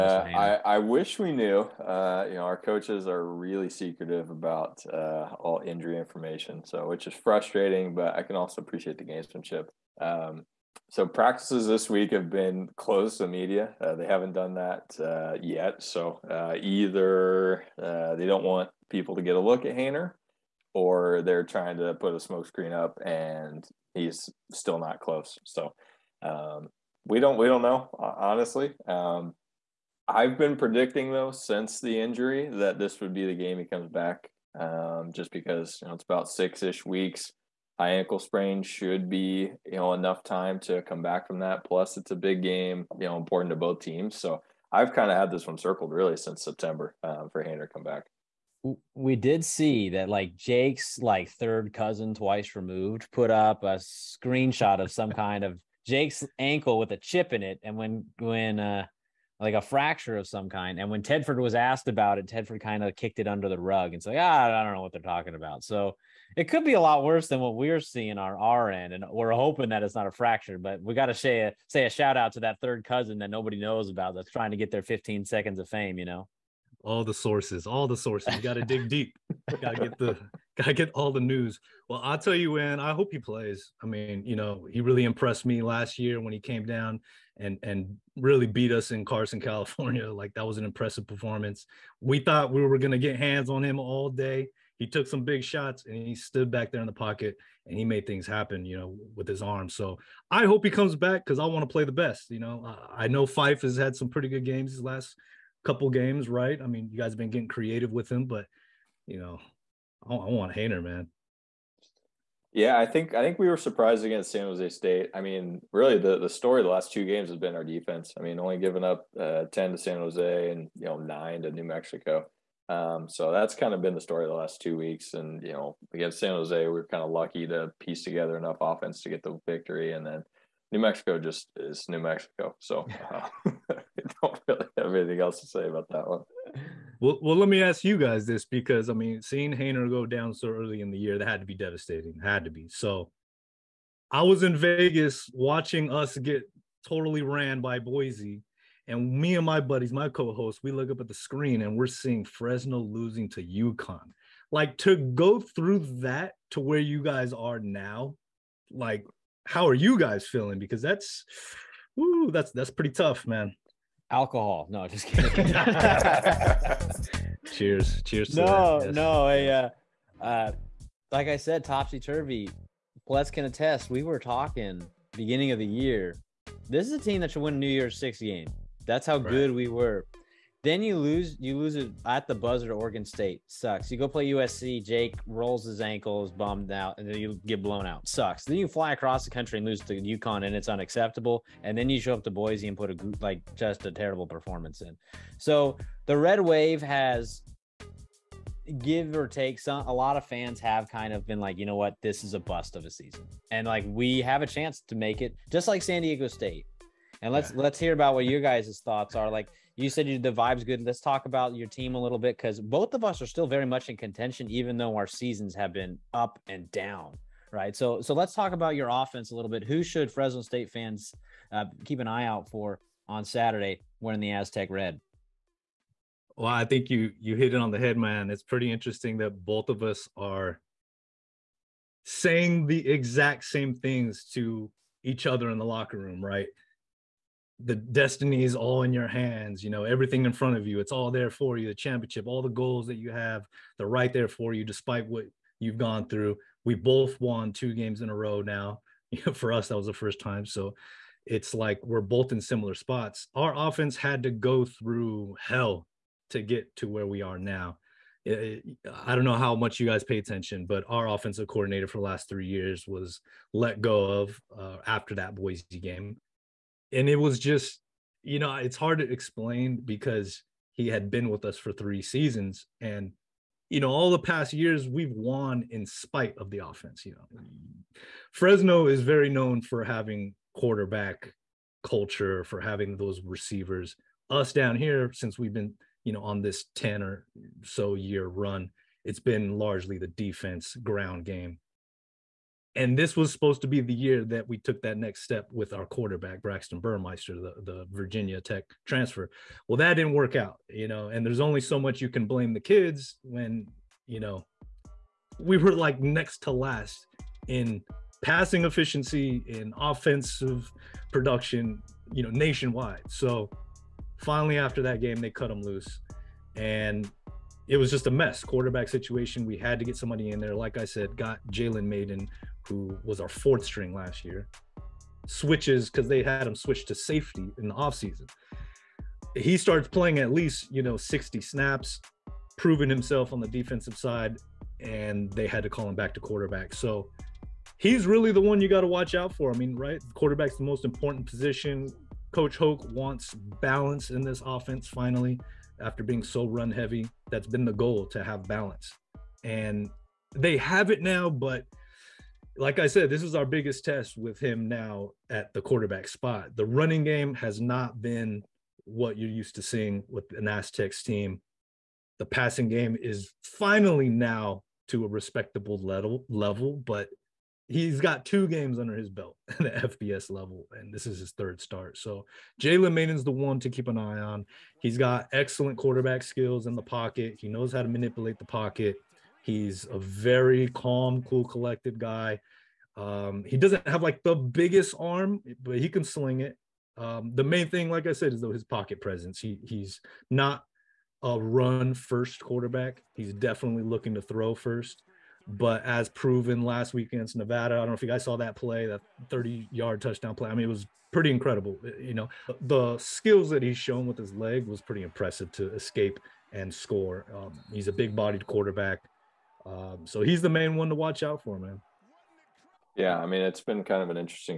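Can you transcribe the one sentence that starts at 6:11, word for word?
So Jalen Mayden's the one to keep an eye on.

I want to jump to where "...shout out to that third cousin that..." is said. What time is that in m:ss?
1:11.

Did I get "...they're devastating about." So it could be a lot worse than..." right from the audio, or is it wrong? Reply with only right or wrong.
wrong.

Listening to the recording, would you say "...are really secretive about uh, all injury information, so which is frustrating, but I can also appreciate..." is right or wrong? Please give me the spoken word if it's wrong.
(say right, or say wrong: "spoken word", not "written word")
right.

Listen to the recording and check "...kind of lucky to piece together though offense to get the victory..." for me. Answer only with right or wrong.
wrong.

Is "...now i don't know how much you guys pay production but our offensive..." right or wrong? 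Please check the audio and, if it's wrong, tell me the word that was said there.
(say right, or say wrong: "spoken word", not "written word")
wrong: "attention", not "production".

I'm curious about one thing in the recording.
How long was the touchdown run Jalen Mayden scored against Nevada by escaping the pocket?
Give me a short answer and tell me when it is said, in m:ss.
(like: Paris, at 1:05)
30 yards, at 6:39.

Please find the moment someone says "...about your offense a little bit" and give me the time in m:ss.
3:38.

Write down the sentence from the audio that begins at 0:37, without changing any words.
High ankle sprain should be you know enough time to come back from that.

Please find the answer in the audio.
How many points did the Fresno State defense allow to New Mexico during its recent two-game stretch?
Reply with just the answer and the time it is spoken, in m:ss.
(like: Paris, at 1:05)
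9, at 2:00.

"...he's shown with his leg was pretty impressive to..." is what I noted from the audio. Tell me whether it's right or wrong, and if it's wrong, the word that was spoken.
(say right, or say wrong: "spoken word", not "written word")
right.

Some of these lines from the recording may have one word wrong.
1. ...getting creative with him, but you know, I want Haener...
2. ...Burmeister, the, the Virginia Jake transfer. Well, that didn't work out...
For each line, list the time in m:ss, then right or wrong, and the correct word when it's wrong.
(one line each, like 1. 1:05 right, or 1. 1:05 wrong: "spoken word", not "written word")
1. 1:47 right
2. 4:56 wrong: "Tech", not "Jake".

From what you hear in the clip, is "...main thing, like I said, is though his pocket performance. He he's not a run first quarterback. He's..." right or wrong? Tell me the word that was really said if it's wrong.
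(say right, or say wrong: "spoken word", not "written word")
wrong: "presence", not "performance".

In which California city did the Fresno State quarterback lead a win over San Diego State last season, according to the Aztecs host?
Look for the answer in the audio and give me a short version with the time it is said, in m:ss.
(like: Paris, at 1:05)
Carson, at 1:29.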